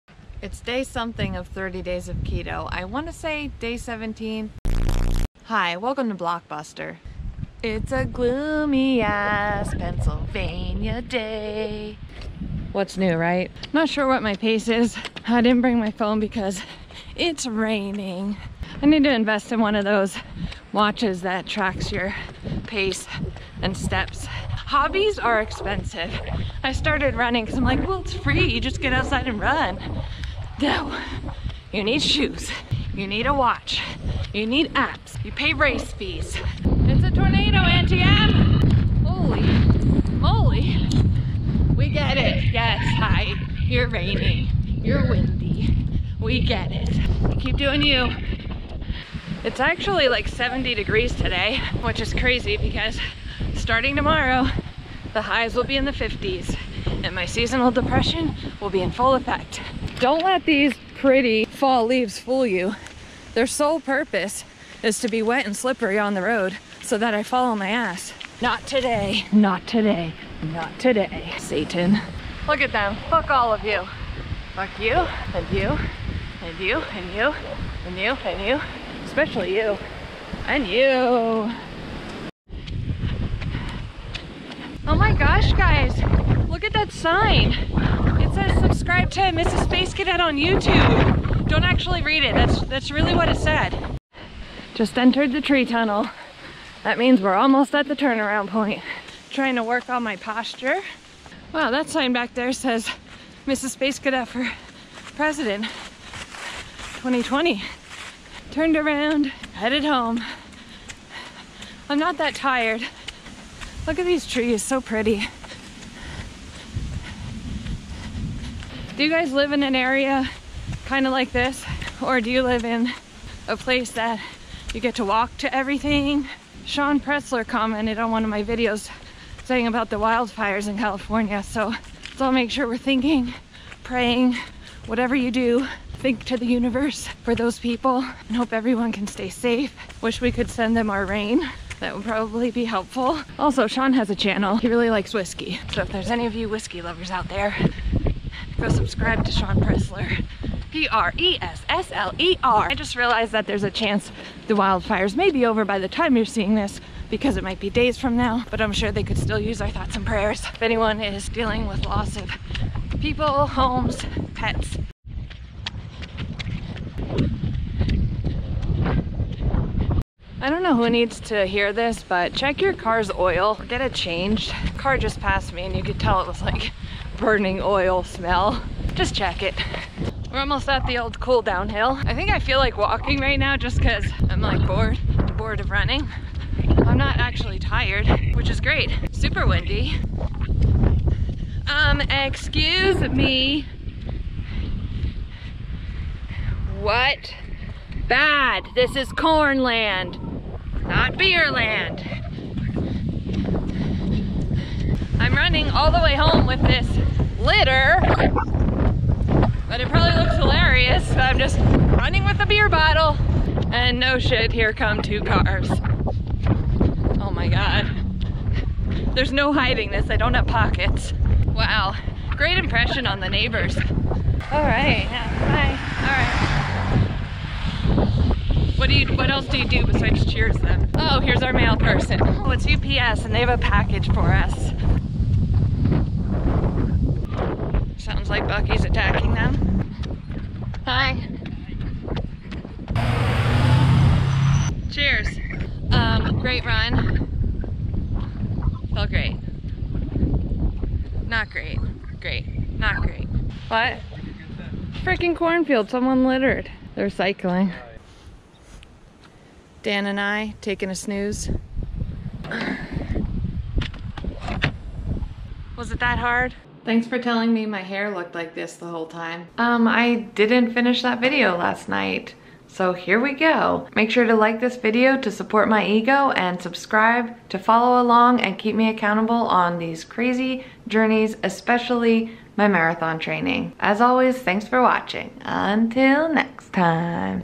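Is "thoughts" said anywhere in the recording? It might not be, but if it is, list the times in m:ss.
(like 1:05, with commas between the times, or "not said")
2:39.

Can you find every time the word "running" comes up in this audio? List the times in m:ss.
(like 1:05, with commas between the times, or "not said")
0:27, 3:05, 3:25, 3:31.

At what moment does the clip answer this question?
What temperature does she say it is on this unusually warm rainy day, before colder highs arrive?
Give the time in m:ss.
0:50.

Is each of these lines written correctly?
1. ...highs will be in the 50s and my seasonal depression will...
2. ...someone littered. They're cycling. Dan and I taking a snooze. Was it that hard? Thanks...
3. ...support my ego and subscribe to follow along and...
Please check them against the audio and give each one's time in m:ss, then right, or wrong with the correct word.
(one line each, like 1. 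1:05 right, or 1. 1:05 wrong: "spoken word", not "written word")
1. 0:55 right
2. 4:15 right
3. 4:35 right.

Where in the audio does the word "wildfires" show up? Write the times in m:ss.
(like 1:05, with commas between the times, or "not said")
2:09, 2:34.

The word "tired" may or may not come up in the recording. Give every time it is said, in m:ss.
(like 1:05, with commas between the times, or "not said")
1:52, 3:07.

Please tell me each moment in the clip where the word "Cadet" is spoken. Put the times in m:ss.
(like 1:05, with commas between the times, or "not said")
1:29, 1:43.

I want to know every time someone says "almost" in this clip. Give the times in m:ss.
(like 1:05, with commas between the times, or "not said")
1:37, 3:00.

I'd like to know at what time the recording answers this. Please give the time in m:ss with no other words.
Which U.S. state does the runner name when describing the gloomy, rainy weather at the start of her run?
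0:09.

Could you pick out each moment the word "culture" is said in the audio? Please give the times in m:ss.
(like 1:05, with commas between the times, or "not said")
not said.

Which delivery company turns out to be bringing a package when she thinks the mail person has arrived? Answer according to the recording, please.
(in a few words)
UPS.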